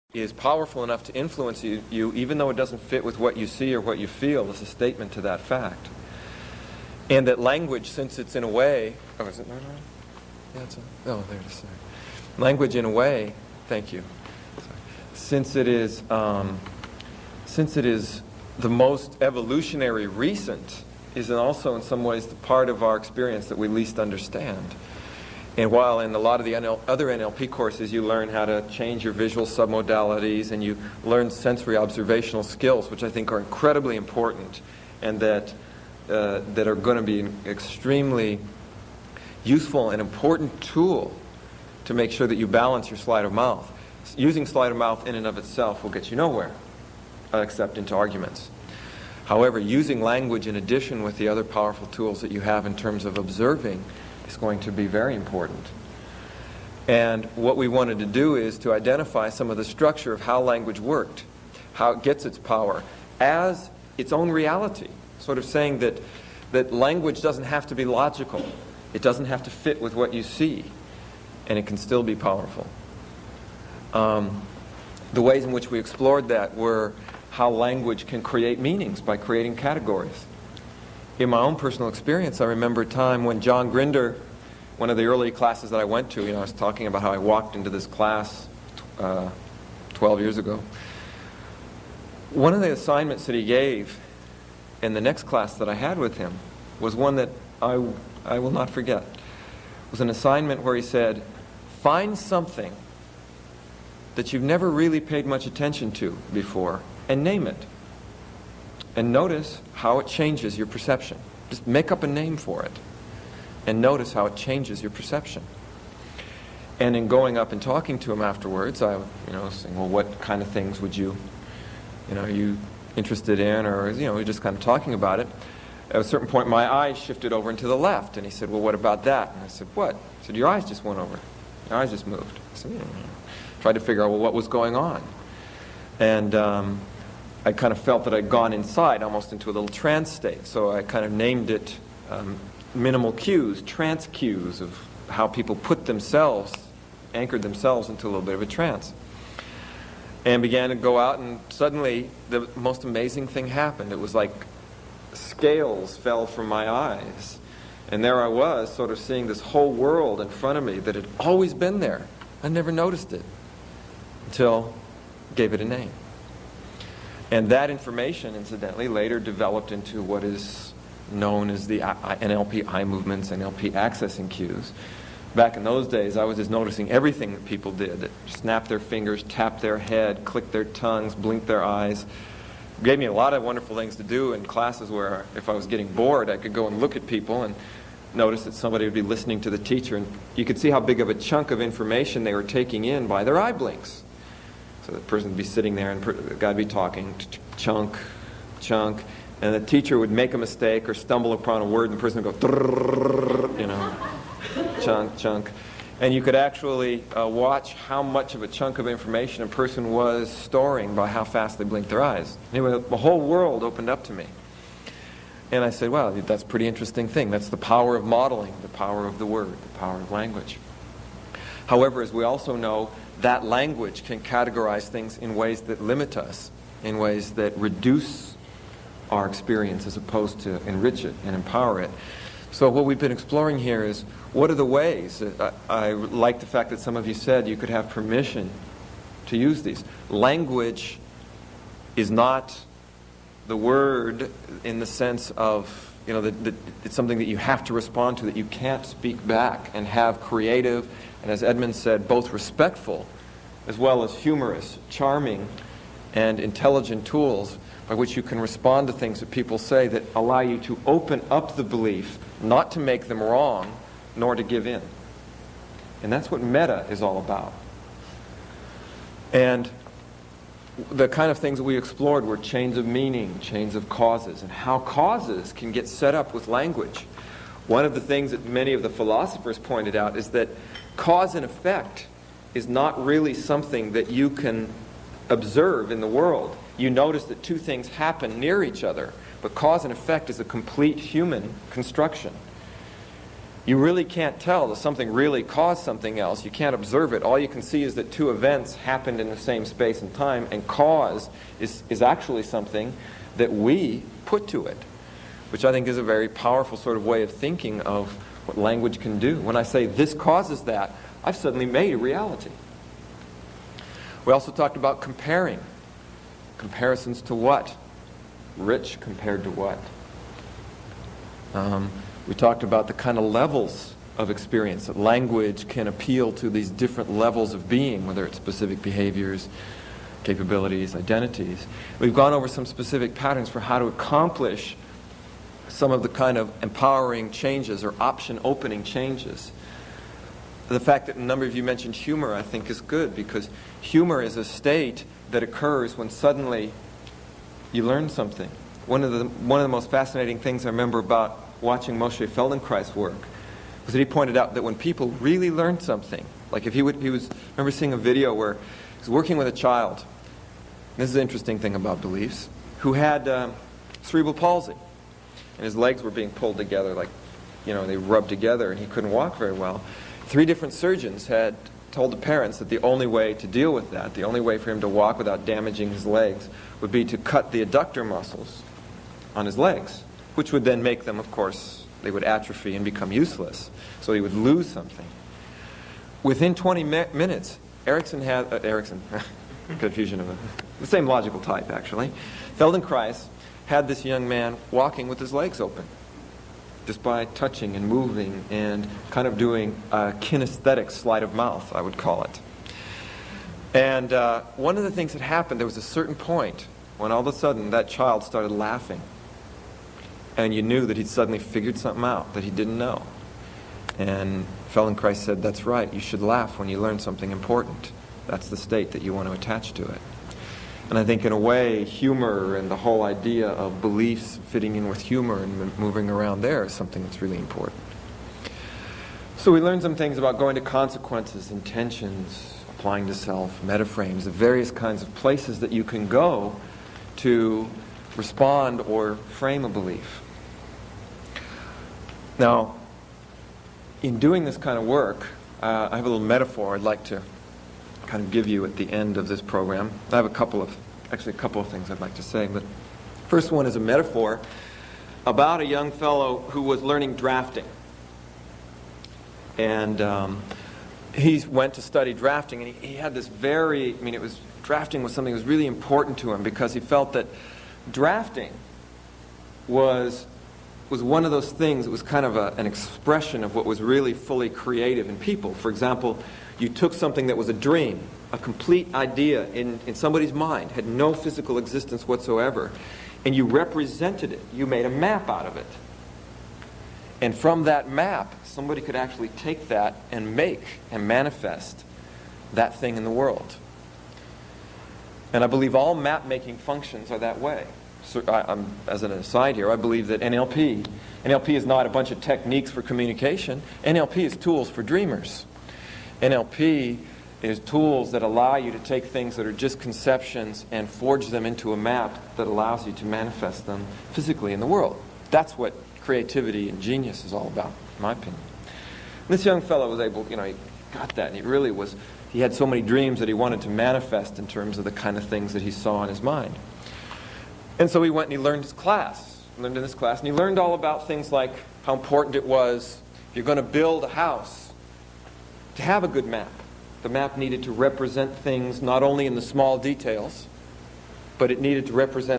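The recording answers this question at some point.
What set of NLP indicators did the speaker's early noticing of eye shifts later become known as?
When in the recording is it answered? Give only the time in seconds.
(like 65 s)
173 s.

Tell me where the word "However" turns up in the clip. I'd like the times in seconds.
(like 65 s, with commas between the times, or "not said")
49 s, 221 s.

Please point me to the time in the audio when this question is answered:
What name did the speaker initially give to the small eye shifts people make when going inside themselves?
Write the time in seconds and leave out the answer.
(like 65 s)
142 s.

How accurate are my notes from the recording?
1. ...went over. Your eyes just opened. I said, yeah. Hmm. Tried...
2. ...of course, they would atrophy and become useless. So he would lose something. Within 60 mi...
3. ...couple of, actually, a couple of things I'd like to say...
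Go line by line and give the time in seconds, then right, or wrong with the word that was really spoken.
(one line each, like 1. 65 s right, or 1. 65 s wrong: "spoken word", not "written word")
1. 130 s wrong: "moved", not "opened"
2. 381 s wrong: "20", not "60"
3. 450 s right.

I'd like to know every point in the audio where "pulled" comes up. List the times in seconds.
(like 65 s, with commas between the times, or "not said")
366 s.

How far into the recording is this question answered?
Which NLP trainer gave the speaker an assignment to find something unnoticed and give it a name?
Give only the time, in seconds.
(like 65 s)
83 s.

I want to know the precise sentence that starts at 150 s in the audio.
And began to go out, and suddenly the most amazing thing happened.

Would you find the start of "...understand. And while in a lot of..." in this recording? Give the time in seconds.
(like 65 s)
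23 s.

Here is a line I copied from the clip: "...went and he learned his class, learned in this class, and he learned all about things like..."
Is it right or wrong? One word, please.
right.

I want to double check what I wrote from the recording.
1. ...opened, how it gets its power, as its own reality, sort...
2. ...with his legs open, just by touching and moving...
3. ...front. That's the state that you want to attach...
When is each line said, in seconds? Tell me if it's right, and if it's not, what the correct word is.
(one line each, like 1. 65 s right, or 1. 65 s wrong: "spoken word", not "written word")
1. 60 s wrong: "worked", not "opened"
2. 395 s right
3. 417 s wrong: "important", not "front".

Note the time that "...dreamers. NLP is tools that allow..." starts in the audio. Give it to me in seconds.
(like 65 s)
504 s.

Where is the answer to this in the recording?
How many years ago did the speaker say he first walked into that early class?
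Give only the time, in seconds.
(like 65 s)
89 s.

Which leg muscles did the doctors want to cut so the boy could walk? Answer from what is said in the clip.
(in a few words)
adductor muscles.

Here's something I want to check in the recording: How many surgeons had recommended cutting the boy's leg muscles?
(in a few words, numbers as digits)
3.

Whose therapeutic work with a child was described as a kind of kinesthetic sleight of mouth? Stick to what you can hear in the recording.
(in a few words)
Moshe Feldenkrais.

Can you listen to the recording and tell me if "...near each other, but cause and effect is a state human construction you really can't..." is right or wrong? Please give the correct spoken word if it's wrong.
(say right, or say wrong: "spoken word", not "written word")
wrong: "complete", not "state".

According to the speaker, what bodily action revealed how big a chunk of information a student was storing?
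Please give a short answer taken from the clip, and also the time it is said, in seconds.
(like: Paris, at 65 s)
eye blinks, at 193 s.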